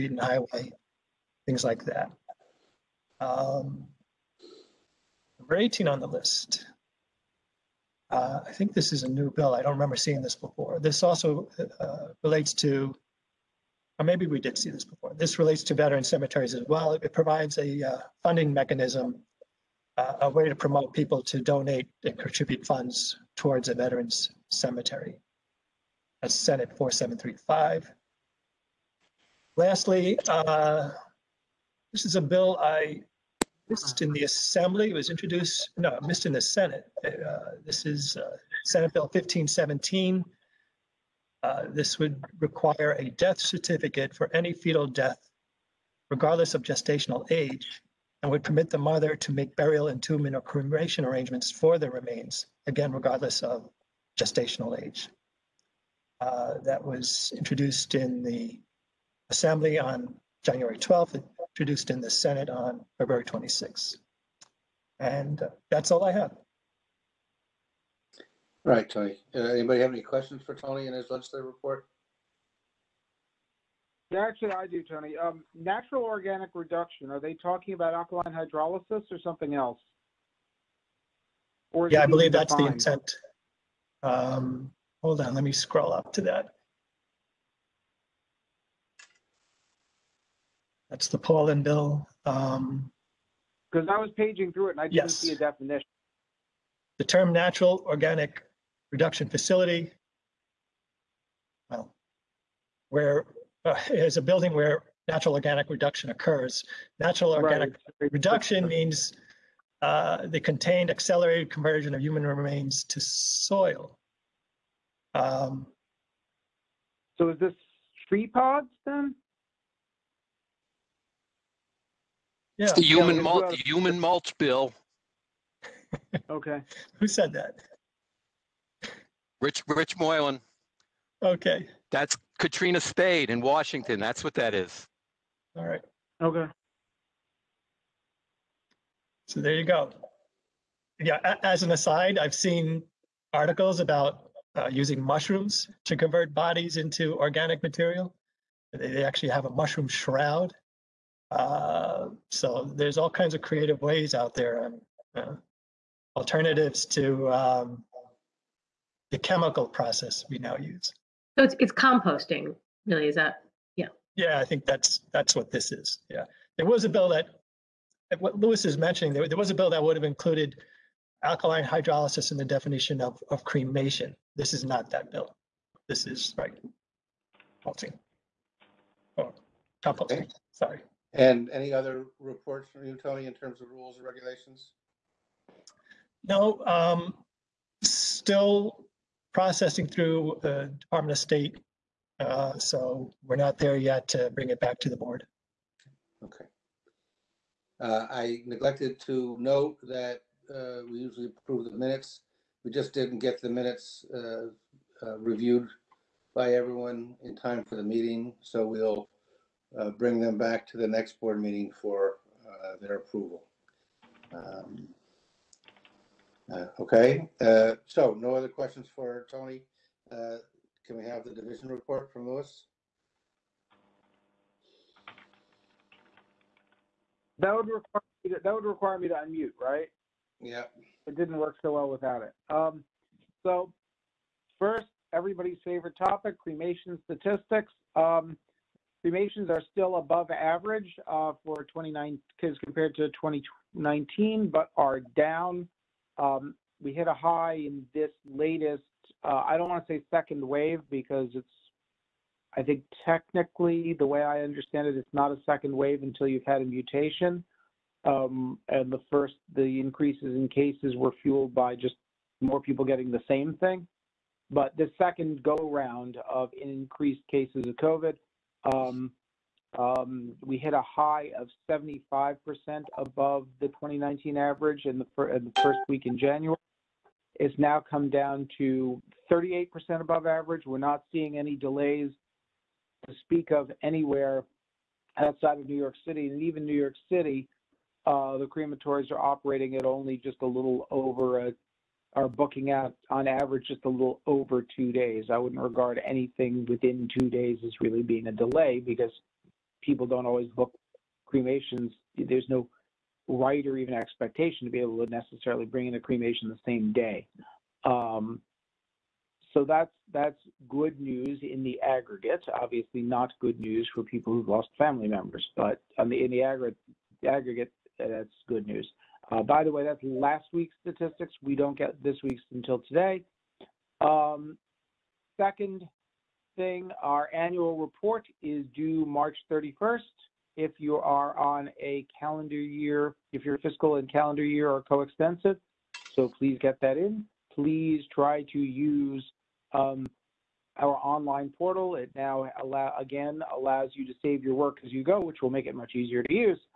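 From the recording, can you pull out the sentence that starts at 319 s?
Uh, by the way, that's last week's statistics.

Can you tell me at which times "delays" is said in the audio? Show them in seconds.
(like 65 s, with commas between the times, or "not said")
281 s, 298 s.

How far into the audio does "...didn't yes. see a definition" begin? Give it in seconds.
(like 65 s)
94 s.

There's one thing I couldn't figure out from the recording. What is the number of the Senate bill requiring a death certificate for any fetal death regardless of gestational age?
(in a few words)
1517.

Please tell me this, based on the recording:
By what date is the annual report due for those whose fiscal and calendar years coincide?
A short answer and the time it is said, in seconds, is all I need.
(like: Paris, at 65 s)
March 31st, at 329 s.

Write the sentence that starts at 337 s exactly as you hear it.
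Please try to use um, our online portal.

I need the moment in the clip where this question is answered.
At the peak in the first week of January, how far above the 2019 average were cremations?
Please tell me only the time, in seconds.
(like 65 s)
271 s.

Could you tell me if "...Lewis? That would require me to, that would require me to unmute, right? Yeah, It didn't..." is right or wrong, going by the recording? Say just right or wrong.
right.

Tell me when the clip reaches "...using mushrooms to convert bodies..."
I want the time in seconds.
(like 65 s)
144 s.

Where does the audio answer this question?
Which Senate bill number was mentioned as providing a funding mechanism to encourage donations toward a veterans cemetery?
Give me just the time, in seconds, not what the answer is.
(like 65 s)
26 s.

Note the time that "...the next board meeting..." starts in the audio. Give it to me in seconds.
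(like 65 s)
210 s.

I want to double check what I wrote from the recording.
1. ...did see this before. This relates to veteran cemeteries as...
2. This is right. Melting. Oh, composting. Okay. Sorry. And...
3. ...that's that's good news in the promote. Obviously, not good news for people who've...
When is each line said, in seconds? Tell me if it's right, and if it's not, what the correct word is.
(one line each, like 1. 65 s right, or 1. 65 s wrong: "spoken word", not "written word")
1. 14 s right
2. 175 s right
3. 309 s wrong: "aggregate", not "promote".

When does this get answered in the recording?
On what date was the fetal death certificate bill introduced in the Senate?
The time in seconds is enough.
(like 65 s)
62 s.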